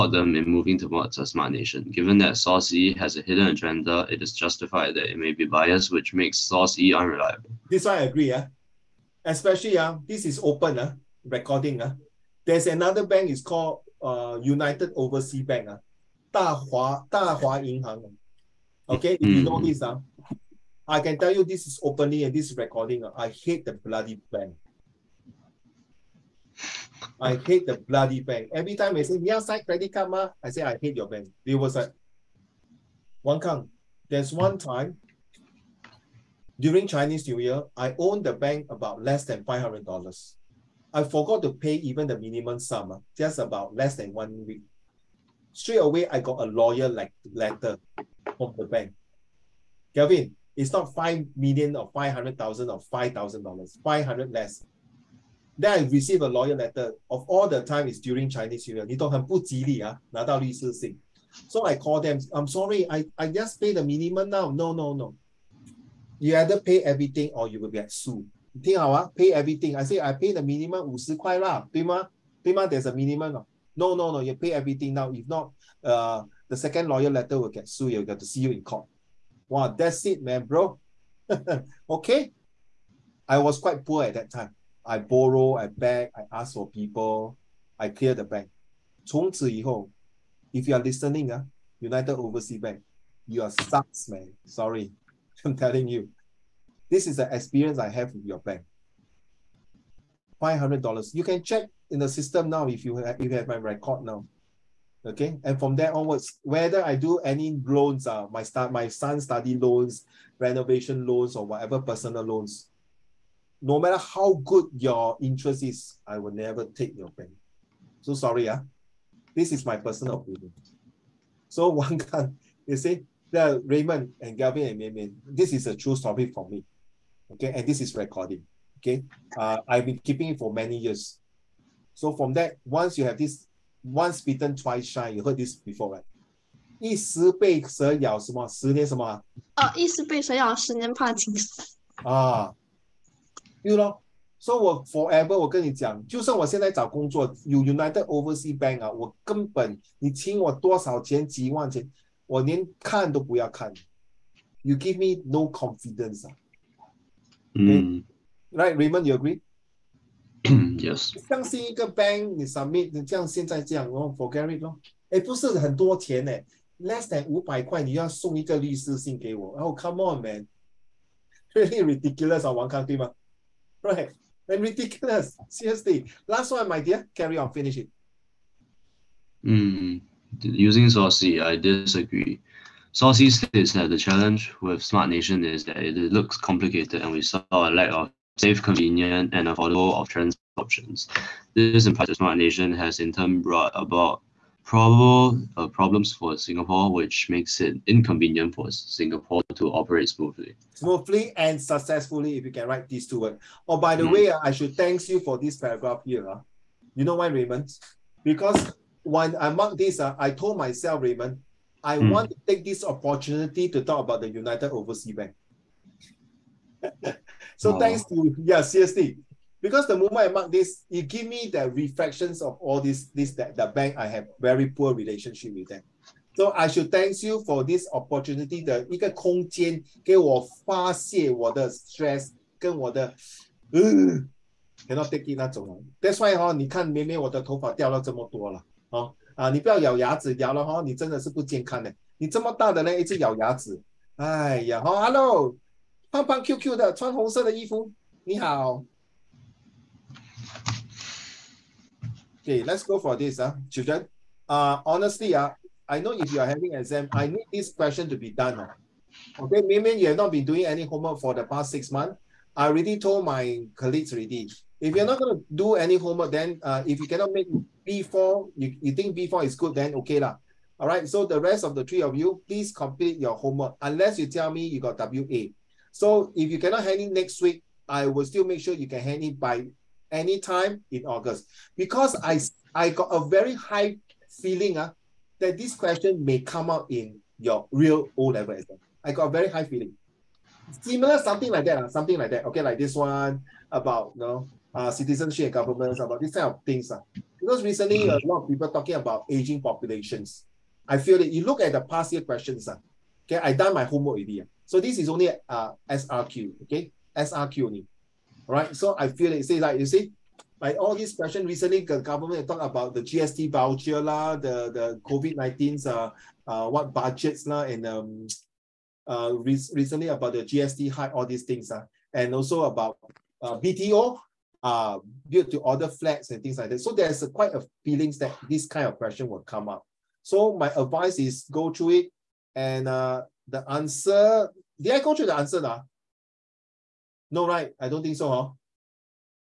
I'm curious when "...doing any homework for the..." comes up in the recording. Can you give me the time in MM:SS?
04:20.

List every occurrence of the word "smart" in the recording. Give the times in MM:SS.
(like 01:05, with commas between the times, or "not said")
00:01, 03:04, 03:12.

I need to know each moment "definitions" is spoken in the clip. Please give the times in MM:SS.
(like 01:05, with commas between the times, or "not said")
not said.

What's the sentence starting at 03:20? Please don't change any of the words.
Smoothly and successfully, if you can write these two words.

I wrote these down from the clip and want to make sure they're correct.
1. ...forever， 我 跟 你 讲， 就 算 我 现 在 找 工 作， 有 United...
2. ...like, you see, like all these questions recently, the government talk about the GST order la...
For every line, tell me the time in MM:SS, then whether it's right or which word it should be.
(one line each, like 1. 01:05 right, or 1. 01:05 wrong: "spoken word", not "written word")
1. 02:24 right
2. 05:09 wrong: "voucher", not "order".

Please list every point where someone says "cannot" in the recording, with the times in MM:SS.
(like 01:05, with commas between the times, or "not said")
04:27, 04:36.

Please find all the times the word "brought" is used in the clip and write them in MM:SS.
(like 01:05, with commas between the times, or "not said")
03:13.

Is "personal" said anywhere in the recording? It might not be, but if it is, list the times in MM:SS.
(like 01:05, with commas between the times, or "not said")
01:51, 01:59.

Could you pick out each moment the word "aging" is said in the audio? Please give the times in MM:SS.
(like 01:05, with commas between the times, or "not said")
04:59.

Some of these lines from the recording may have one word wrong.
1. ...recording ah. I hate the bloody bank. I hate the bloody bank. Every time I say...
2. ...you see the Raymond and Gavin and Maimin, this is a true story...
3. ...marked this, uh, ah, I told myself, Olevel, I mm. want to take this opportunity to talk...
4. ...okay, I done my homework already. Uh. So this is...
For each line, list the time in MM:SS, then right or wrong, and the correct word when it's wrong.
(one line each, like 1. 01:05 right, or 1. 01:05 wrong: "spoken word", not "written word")
1. 00:22 right
2. 02:02 right
3. 03:29 wrong: "Raymond", not "Olevel"
4. 05:03 right.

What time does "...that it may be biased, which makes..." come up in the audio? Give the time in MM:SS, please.
00:04.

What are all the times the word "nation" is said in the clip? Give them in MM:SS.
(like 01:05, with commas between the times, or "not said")
00:01, 03:05, 03:12.